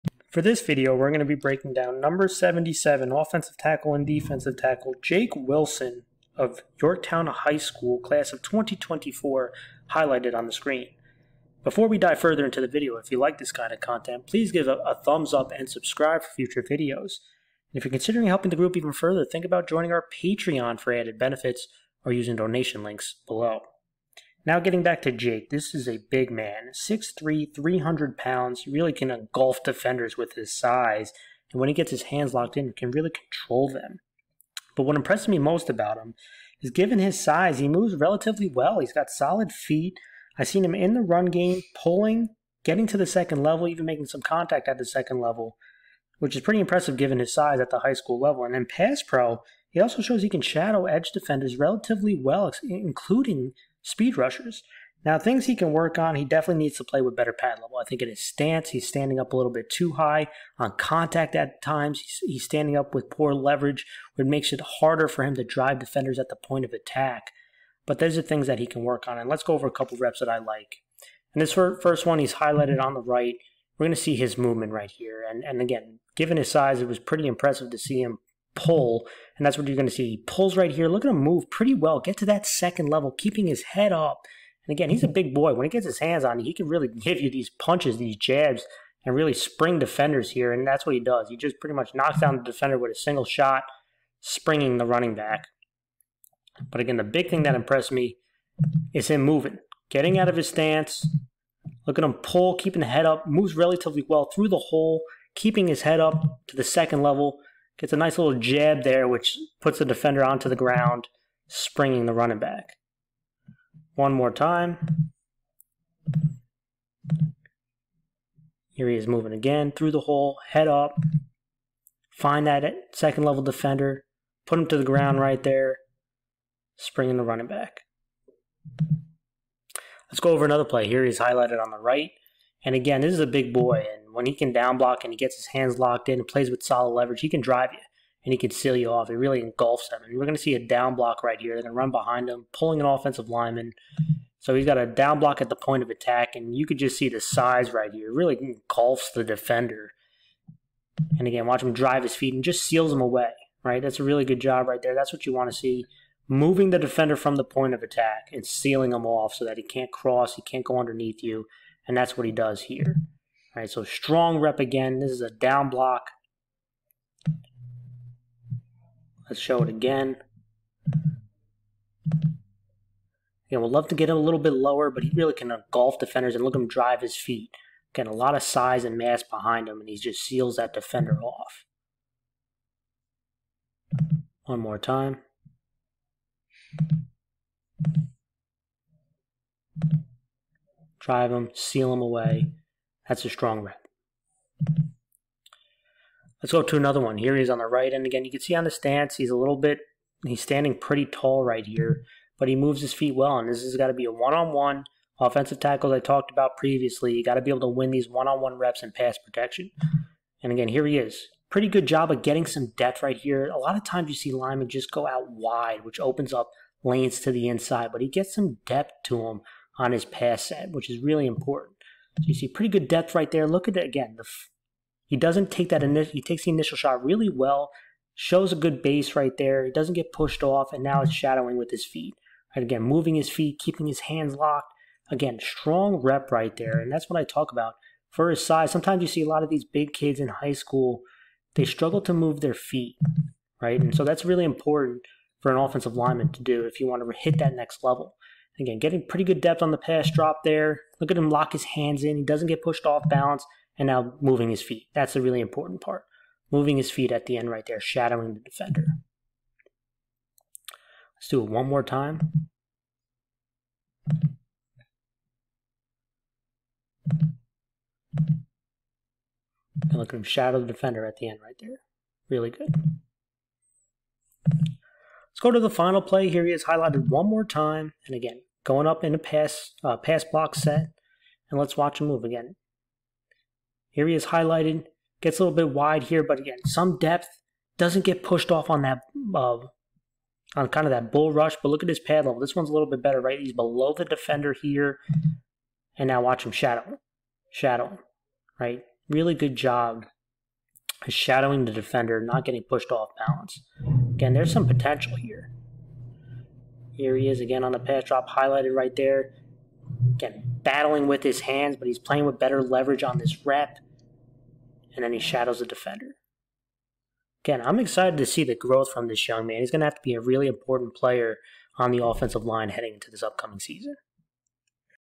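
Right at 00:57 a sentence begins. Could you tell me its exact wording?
I think in his stance, he's standing up a little bit too high on contact at times.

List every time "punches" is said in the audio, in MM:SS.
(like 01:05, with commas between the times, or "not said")
01:27.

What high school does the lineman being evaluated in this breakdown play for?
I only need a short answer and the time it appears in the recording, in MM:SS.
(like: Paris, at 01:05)
Yorktown High School, at 00:06.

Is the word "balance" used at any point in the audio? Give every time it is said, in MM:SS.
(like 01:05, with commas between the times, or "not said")
04:13, 05:03.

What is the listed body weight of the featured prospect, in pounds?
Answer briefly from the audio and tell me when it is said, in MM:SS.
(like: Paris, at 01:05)
300, at 00:27.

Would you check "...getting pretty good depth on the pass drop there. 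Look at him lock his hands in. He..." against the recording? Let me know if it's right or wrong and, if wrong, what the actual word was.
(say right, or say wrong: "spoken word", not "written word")
right.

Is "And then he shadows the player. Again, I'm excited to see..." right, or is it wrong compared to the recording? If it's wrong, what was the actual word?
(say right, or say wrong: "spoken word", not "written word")
wrong: "defender", not "player".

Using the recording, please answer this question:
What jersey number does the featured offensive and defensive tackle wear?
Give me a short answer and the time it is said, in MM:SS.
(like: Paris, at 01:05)
77, at 00:02.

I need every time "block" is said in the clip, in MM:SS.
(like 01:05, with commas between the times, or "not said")
02:14, 02:20, 02:25, 02:45, 04:40.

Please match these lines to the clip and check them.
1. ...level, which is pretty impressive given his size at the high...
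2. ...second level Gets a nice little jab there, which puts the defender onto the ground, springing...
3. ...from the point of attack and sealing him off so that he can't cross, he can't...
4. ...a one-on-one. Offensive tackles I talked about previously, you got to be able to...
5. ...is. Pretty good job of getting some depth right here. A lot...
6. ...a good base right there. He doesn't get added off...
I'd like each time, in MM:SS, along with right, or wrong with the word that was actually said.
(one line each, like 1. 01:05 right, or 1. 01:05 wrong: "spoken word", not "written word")
1. 00:45 right
2. 01:46 right
3. 02:37 right
4. 03:24 right
5. 03:30 right
6. 03:48 wrong: "pushed", not "added".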